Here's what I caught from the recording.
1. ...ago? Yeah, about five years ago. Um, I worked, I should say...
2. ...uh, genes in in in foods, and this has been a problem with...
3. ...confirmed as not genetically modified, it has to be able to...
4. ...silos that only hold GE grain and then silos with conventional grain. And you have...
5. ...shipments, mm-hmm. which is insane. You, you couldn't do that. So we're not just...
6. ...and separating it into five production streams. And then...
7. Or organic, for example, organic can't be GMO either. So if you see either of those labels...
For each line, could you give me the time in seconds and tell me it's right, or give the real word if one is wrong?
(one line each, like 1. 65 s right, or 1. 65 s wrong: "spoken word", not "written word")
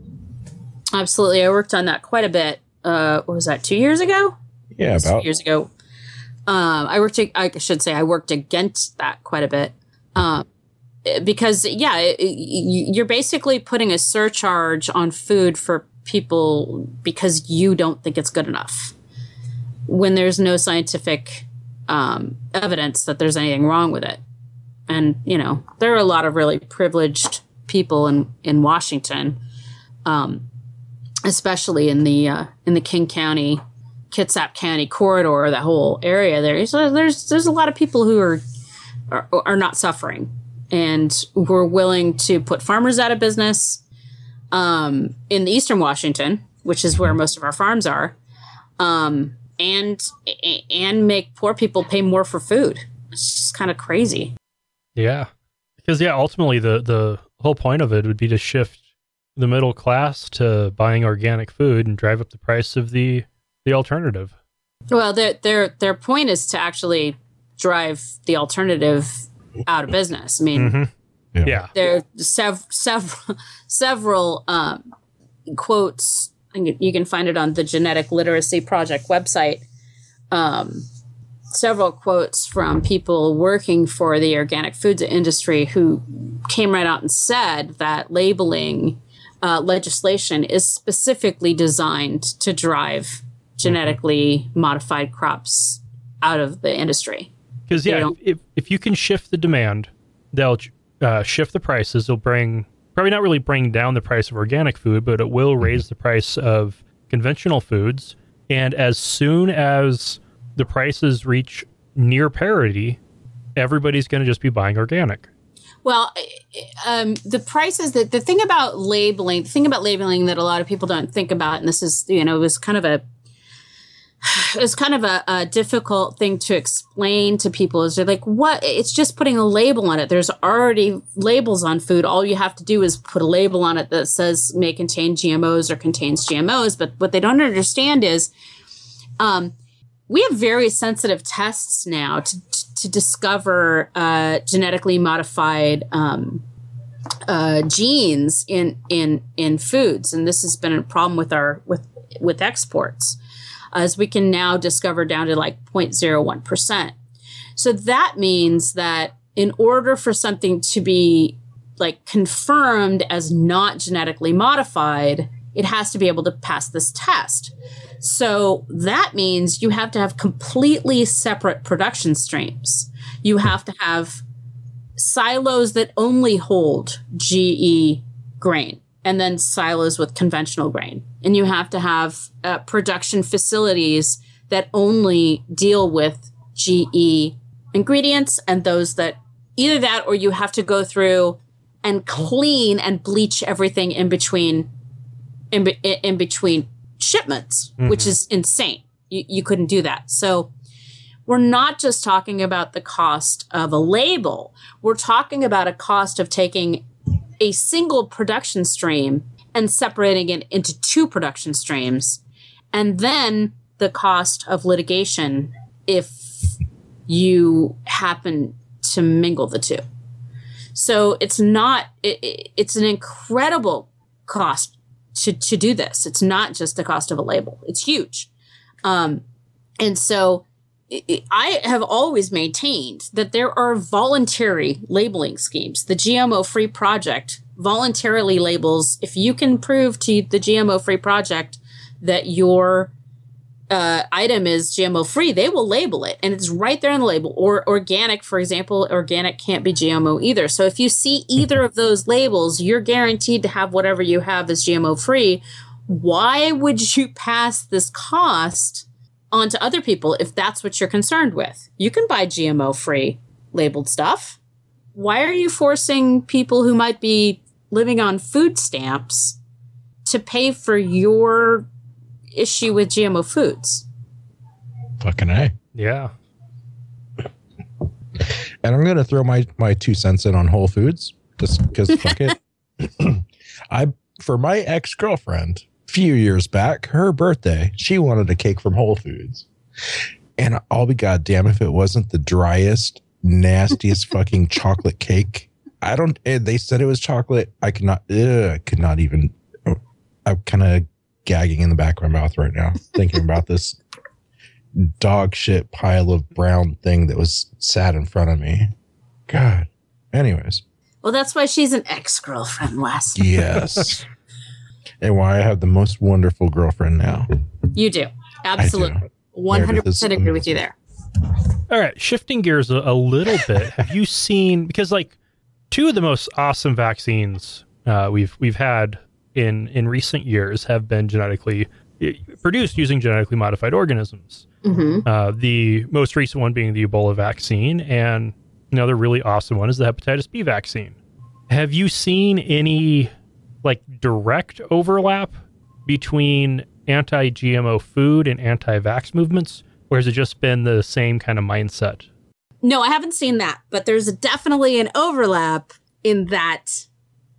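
1. 3 s wrong: "two", not "five"
2. 147 s right
3. 162 s right
4. 174 s right
5. 196 s right
6. 209 s wrong: "two", not "five"
7. 247 s right.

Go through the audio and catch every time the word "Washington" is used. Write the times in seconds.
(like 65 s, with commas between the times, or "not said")
28 s, 45 s.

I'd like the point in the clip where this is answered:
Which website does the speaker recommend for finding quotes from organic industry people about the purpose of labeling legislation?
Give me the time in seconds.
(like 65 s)
77 s.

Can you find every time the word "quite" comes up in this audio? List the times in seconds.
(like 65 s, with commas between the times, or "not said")
2 s, 9 s.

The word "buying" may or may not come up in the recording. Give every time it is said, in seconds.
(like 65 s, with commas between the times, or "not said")
60 s, 114 s.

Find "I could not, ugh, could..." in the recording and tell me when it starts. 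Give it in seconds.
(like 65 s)
297 s.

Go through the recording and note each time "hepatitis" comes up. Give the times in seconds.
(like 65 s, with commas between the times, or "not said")
339 s.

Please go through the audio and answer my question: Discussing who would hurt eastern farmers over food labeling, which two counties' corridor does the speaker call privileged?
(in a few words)
King County, Kitsap County.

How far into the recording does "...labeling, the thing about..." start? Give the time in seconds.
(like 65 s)
118 s.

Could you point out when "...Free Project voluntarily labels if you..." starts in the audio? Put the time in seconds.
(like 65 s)
236 s.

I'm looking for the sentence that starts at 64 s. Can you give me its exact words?
Well, their their their point is to actually drive the alternative out of business.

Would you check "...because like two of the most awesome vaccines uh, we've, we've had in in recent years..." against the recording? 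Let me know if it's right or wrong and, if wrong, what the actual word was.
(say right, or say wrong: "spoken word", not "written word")
right.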